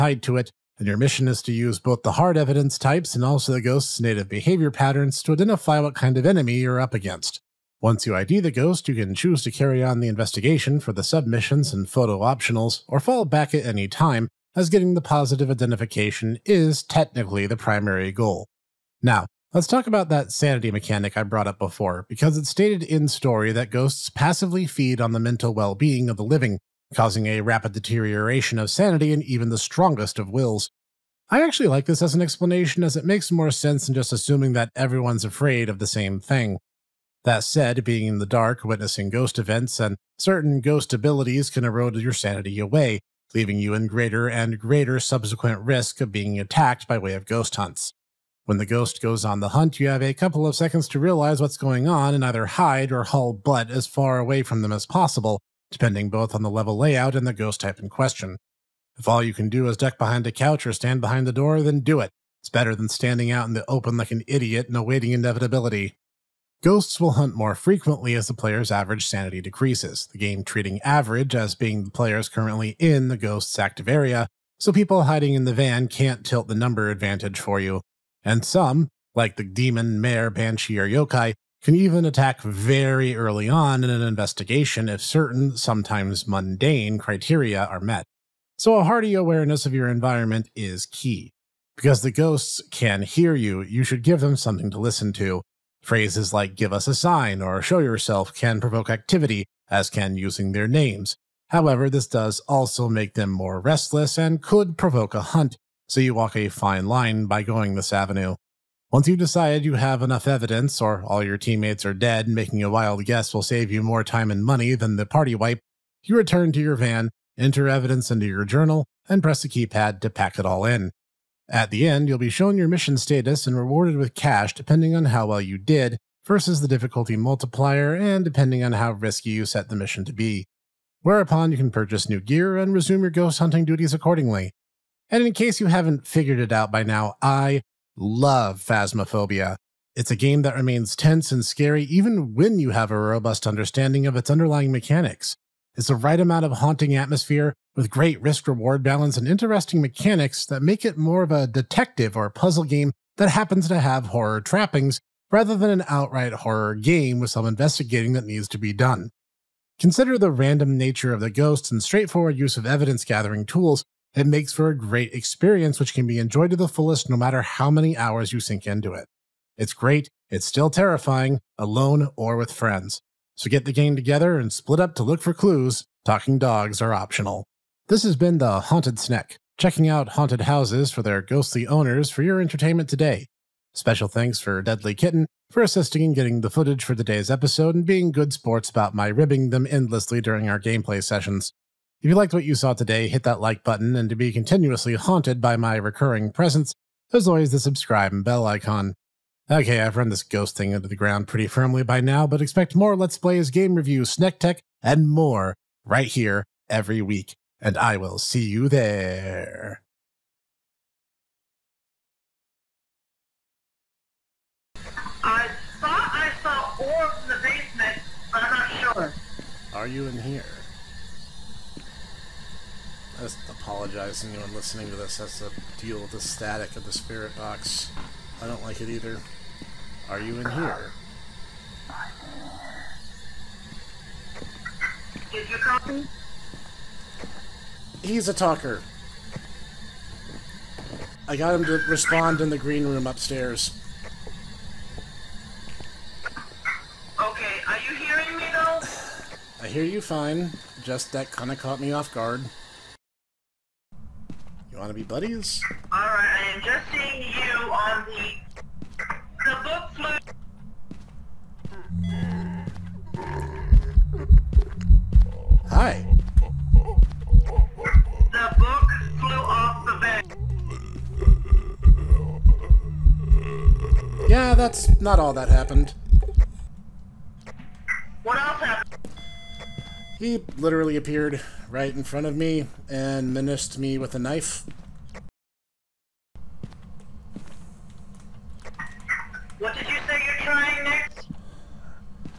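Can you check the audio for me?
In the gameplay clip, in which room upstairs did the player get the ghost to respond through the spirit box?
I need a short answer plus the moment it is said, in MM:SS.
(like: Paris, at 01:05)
The green room, at 04:02.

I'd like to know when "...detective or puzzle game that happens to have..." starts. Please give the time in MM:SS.
02:31.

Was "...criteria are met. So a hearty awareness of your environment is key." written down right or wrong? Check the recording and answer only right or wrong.
right.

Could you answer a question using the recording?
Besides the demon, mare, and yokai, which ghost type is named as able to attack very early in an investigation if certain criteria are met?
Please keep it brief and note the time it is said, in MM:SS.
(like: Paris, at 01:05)
Banshee, at 01:20.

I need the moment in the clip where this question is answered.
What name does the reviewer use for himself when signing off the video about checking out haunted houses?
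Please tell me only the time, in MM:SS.
02:58.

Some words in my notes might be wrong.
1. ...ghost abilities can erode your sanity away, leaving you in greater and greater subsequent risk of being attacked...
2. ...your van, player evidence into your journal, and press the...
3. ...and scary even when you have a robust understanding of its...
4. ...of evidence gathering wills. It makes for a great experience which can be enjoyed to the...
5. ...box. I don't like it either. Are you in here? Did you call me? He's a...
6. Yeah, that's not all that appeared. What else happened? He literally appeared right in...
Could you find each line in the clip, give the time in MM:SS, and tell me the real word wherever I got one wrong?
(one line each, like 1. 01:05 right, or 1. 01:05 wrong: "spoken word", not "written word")
1. 00:40 right
2. 01:56 wrong: "enter", not "player"
3. 02:21 right
4. 02:42 wrong: "tools", not "wills"
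5. 03:47 right
6. 04:34 wrong: "happened", not "appeared".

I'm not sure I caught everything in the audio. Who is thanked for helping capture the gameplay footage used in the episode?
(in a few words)
Deadly Kitten.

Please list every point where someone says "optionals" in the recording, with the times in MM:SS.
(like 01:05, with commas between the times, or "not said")
00:12, 02:56.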